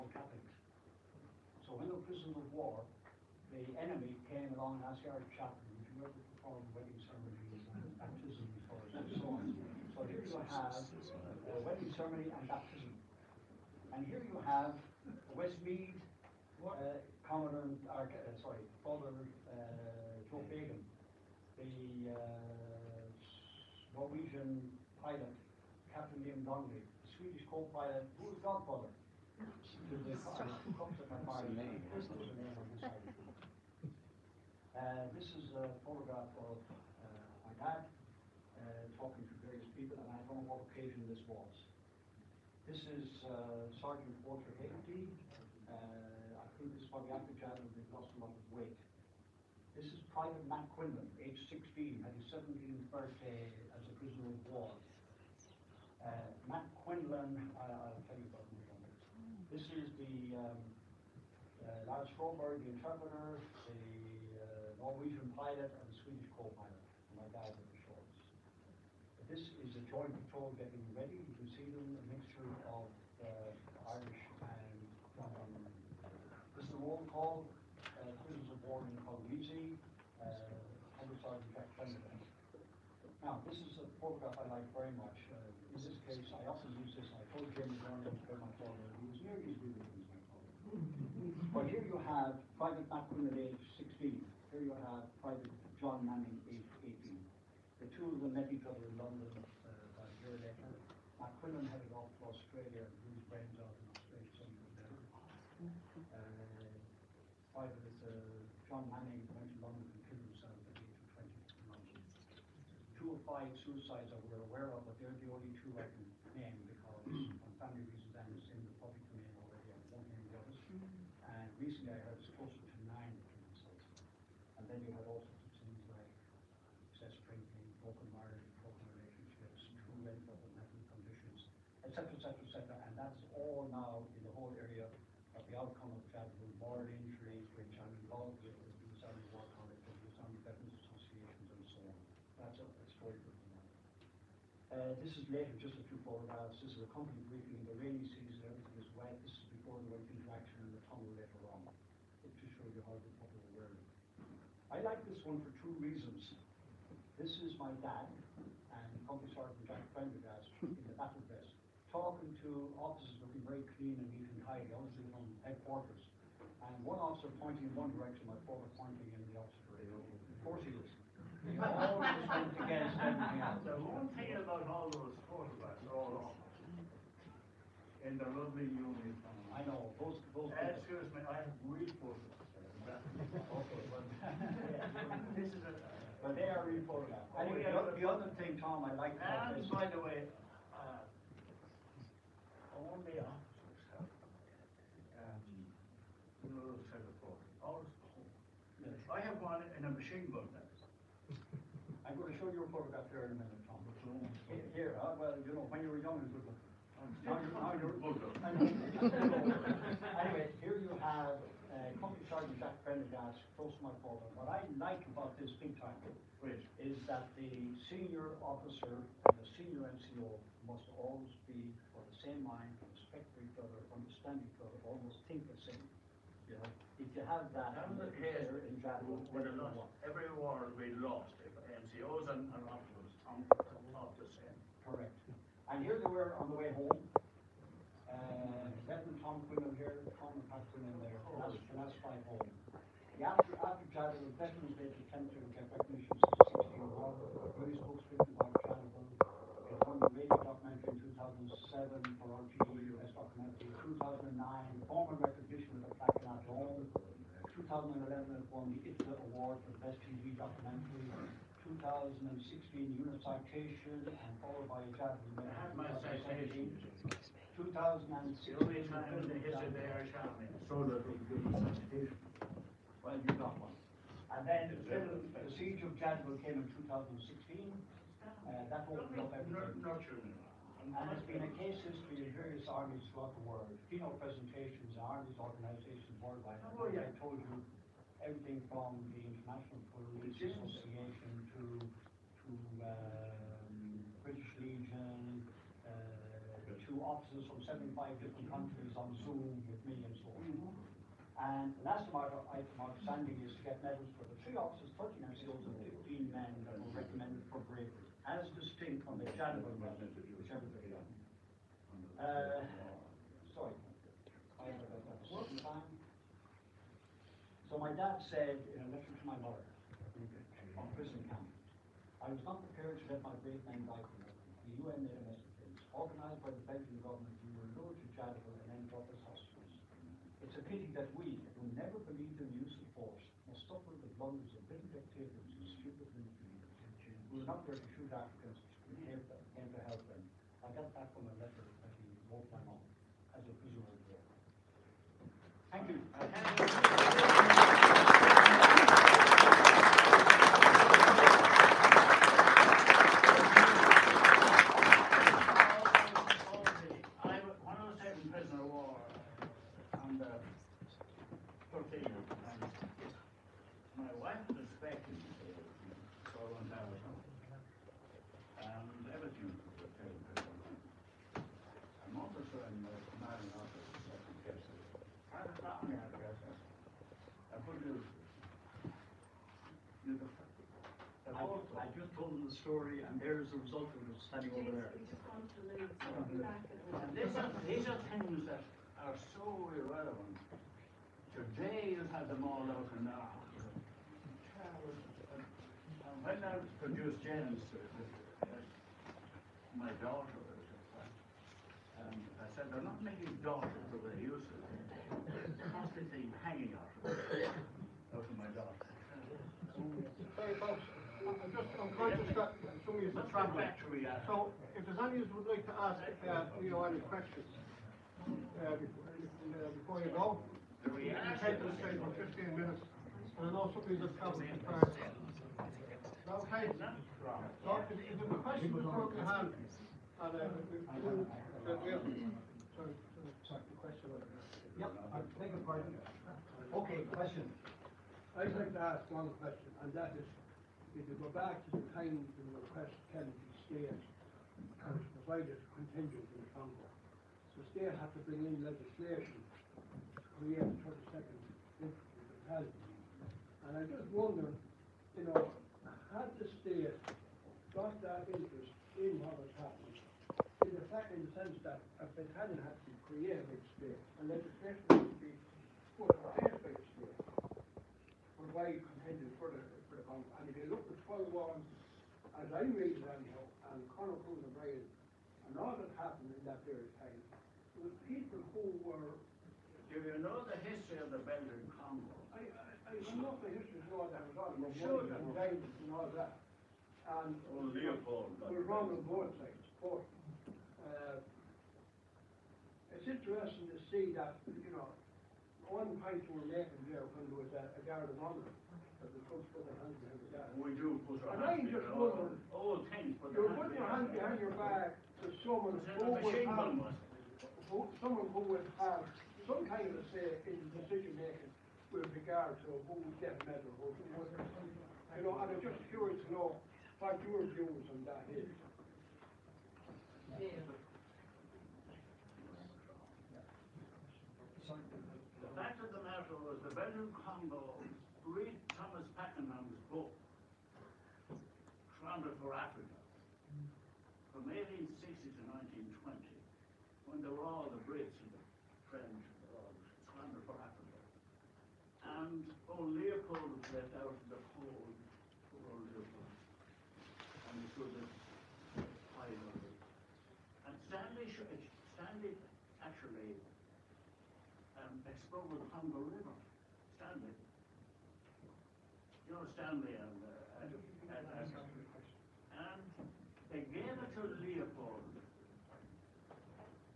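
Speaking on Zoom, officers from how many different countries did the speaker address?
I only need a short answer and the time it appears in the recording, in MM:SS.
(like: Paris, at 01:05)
75, at 04:57.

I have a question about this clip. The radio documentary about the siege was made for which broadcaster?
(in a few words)
RTE.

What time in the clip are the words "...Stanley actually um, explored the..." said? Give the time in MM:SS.
09:11.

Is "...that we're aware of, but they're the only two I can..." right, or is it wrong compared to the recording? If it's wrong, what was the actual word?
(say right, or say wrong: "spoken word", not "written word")
right.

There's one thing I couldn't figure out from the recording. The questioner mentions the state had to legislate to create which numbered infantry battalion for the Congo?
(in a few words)
32nd.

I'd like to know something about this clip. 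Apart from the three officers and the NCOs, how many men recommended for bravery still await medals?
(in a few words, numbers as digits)
15.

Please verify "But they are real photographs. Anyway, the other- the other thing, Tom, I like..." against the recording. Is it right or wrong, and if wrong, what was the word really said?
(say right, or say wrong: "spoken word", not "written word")
right.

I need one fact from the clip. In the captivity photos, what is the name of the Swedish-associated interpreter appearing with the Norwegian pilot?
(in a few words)
Lars Froberg.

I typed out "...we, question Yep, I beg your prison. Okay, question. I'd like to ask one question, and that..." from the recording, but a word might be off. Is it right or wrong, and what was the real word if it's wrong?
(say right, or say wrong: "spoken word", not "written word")
wrong: "pardon", not "prison".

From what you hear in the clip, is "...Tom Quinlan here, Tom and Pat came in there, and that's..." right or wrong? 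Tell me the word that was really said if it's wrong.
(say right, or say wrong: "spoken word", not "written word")
right.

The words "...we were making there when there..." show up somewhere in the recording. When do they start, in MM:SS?
08:16.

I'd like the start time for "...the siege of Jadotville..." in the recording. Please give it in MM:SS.
04:34.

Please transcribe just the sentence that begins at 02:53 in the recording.
The one thing about all those photographs, all of them, in the lovely uniform.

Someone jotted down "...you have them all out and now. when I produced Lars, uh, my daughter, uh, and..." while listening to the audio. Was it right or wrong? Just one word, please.
wrong.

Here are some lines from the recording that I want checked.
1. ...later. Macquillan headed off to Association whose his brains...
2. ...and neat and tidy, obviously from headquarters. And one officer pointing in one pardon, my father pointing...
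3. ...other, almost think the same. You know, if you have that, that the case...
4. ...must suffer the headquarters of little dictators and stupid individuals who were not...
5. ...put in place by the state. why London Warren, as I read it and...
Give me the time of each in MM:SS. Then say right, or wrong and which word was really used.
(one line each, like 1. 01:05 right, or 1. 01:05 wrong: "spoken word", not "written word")
1. 01:40 wrong: "Australia", not "Association"
2. 02:43 wrong: "direction", not "pardon"
3. 03:44 right
4. 05:33 wrong: "blunders", not "headquarters"
5. 07:46 wrong: "Paul", not "London".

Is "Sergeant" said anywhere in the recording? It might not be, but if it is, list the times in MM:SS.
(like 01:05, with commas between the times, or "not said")
00:43, 02:39, 03:32.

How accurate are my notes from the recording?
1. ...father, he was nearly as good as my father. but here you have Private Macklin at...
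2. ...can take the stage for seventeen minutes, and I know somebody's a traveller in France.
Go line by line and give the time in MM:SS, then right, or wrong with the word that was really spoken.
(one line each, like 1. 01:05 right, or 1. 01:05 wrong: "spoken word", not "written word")
1. 01:28 right
2. 07:01 wrong: "fifteen", not "seventeen".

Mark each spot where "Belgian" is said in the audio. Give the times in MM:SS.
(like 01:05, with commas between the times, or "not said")
05:26, 08:01, 08:46.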